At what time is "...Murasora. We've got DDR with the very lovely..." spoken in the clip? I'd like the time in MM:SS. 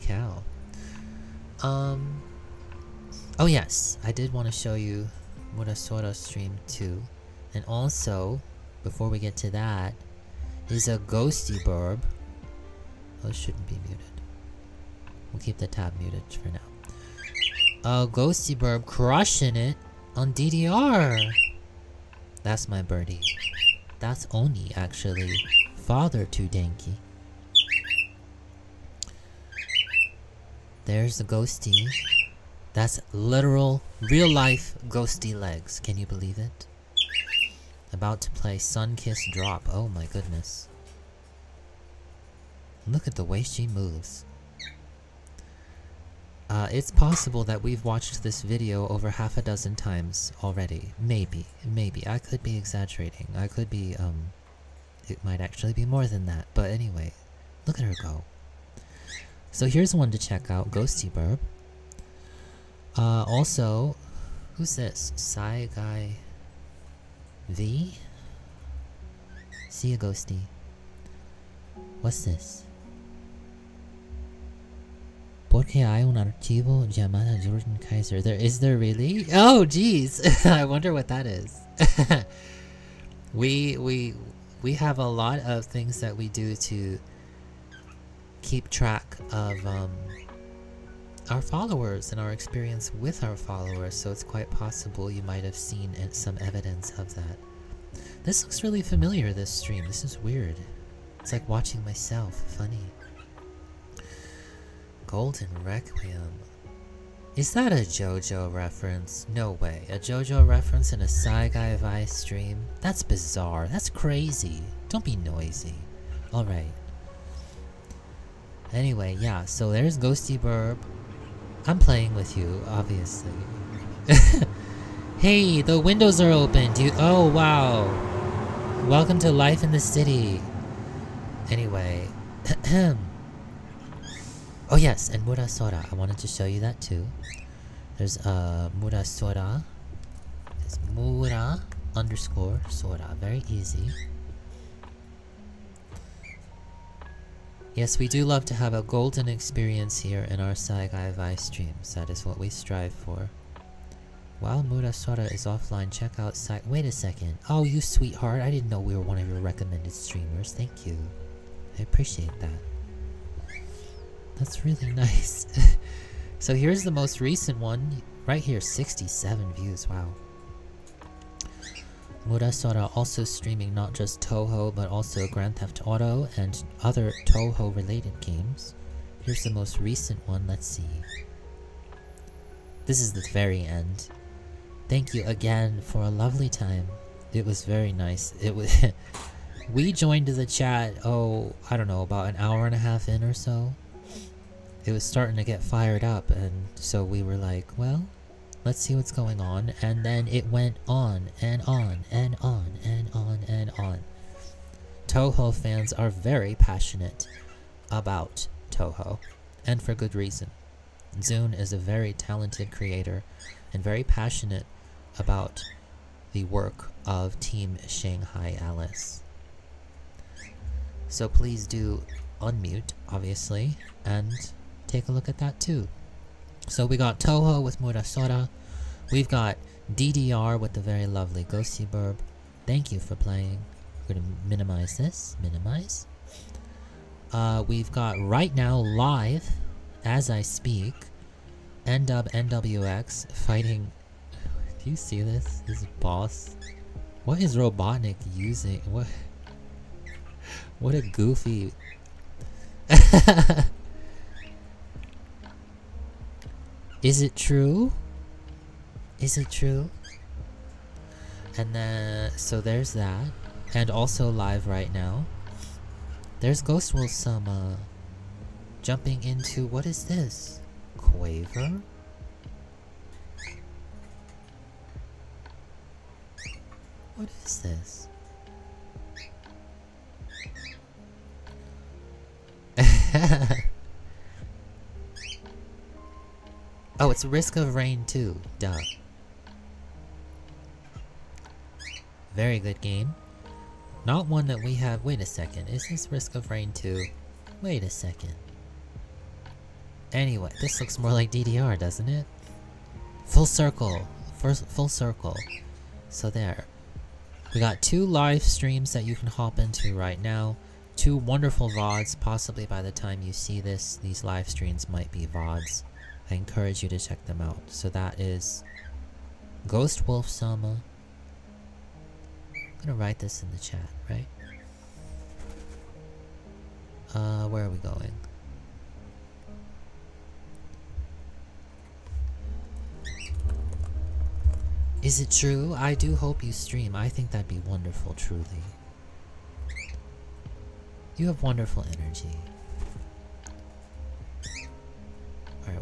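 03:47.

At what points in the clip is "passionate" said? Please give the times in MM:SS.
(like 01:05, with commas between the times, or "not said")
03:26, 03:34.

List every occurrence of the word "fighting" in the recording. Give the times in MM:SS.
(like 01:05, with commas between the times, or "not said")
04:03.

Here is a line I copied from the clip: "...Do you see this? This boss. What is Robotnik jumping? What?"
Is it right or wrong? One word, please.
wrong.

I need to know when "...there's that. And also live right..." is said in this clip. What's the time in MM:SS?
04:22.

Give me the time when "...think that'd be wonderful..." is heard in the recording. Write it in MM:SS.
05:37.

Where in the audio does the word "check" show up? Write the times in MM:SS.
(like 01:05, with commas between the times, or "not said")
01:00, 02:35, 05:16.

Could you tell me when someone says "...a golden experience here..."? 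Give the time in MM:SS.
02:28.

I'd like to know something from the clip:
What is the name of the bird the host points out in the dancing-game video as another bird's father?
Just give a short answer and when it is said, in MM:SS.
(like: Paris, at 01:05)
Oni, at 00:24.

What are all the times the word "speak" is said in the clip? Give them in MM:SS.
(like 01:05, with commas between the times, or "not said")
04:00.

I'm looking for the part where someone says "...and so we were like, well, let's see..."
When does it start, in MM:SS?
03:16.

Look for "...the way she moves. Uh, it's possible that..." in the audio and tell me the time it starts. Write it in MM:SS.
00:43.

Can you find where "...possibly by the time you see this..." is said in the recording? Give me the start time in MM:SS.
05:12.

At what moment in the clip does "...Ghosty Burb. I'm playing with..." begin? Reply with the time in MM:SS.
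01:59.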